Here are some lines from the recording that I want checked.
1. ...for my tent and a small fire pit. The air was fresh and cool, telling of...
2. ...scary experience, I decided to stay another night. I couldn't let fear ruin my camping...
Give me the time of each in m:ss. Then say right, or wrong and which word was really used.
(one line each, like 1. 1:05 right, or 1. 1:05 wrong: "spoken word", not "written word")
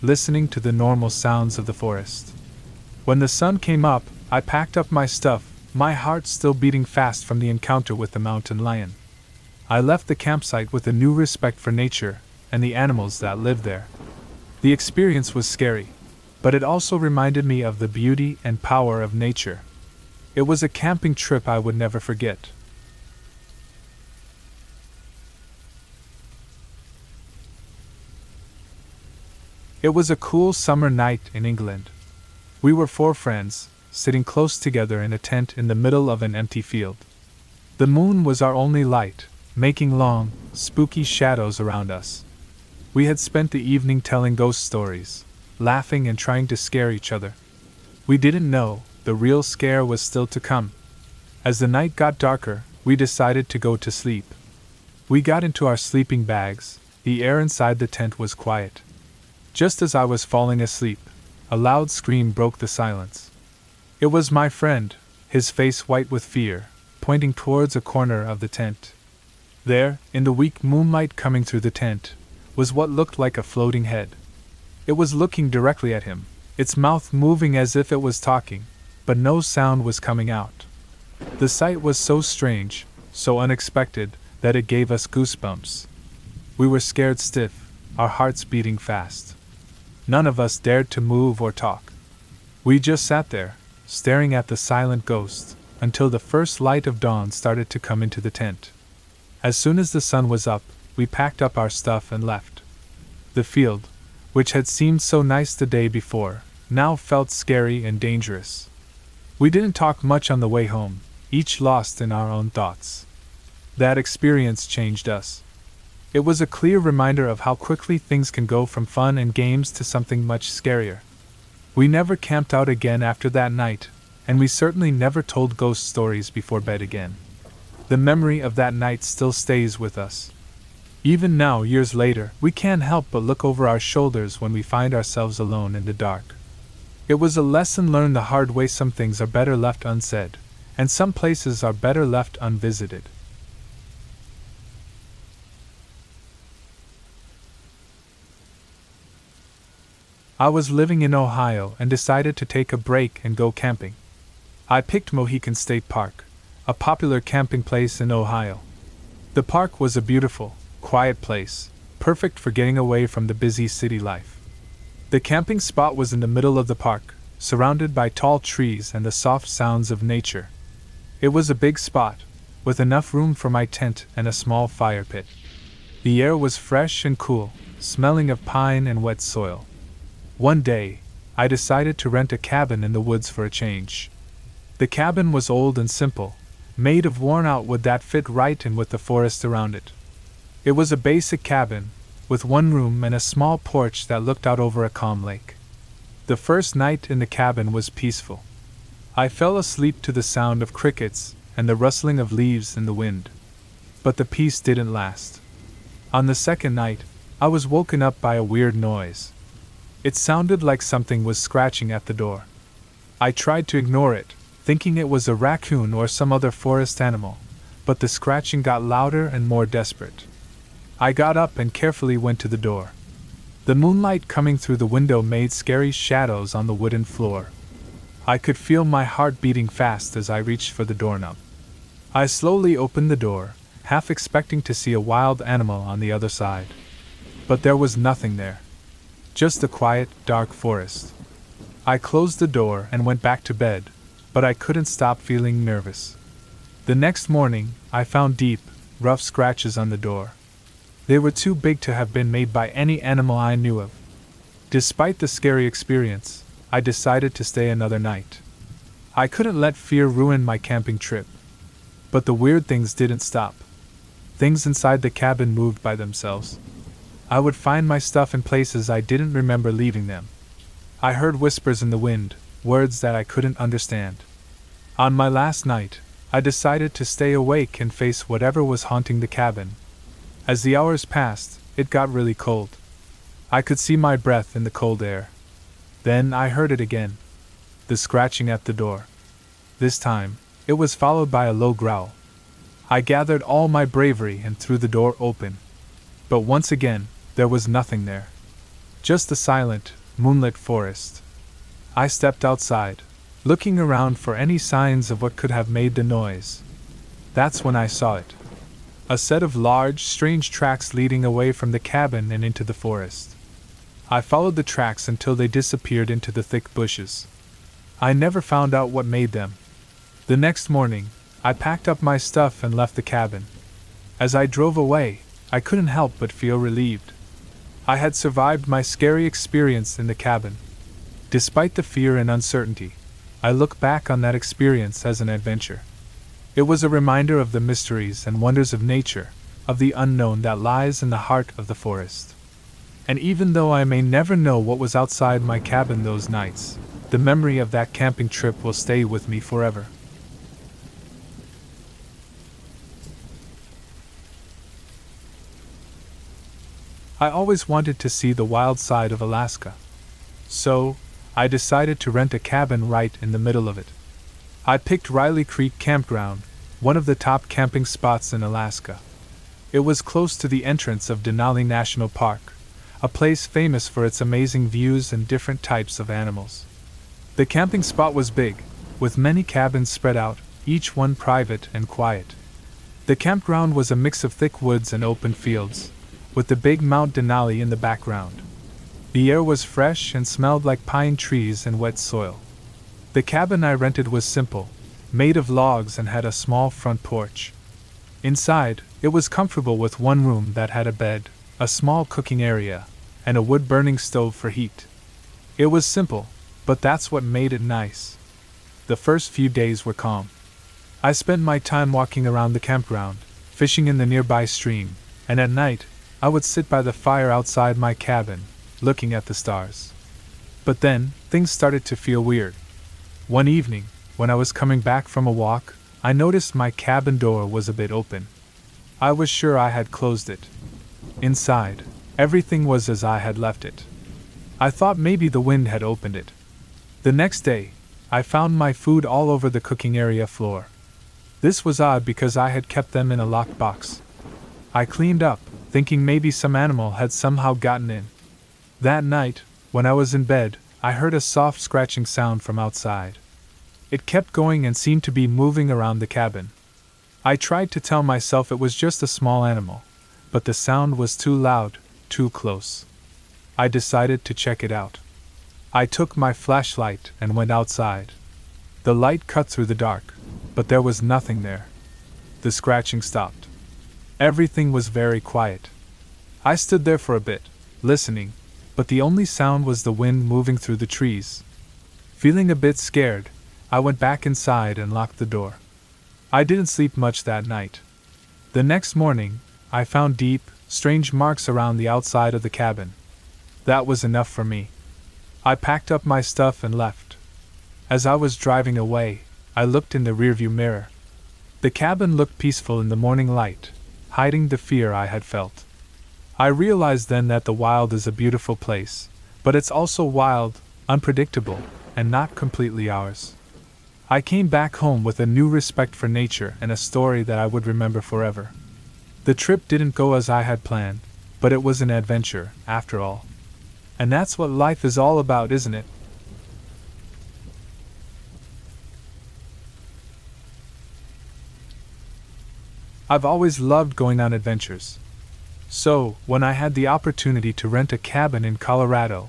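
1. 2:53 wrong: "smelling", not "telling"
2. 4:15 right.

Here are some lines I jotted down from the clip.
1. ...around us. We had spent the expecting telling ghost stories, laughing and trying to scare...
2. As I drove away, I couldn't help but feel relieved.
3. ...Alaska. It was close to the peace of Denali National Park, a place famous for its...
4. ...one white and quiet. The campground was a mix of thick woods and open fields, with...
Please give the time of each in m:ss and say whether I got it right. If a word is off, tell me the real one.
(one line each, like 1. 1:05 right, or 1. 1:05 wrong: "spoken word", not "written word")
1. 0:41 wrong: "evening", not "expecting"
2. 5:24 right
3. 6:08 wrong: "entrance", not "peace"
4. 6:20 wrong: "private", not "white".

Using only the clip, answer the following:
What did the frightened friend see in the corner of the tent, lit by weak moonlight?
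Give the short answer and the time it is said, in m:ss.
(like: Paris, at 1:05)
A floating head, at 1:13.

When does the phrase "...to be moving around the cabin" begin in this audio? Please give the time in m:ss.
7:35.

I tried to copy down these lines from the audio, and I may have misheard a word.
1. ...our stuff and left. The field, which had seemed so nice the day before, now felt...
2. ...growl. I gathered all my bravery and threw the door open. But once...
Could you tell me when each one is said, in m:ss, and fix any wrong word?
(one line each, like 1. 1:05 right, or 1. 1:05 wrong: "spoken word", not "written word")
1. 1:41 right
2. 4:51 right.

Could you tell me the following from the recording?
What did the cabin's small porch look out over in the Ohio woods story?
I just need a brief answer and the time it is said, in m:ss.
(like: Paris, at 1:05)
A calm lake, at 3:14.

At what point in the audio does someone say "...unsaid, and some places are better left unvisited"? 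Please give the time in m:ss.
2:19.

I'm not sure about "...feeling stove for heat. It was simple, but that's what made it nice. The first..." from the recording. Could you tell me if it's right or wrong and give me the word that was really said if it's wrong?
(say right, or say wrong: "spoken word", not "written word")
wrong: "burning", not "feeling".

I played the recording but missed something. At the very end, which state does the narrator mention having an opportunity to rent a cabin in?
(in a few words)
Colorado.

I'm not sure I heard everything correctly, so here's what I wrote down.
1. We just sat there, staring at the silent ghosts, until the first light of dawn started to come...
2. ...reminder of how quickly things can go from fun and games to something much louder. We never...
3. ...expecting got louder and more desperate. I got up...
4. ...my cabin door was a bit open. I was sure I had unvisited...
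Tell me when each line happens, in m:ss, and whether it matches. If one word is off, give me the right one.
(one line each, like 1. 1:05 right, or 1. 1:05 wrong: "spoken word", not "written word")
1. 1:32 right
2. 1:56 wrong: "scarier", not "louder"
3. 3:38 wrong: "scratching", not "expecting"
4. 7:06 wrong: "closed", not "unvisited".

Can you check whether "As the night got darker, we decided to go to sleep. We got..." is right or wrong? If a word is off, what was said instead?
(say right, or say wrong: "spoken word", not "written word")
right.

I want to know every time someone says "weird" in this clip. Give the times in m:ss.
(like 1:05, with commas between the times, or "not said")
3:28, 4:22, 7:02.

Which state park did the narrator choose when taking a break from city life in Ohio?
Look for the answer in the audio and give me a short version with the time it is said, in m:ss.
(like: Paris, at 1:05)
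Mohican State Park, at 2:35.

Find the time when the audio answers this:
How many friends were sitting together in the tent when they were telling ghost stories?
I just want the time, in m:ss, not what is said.
0:32.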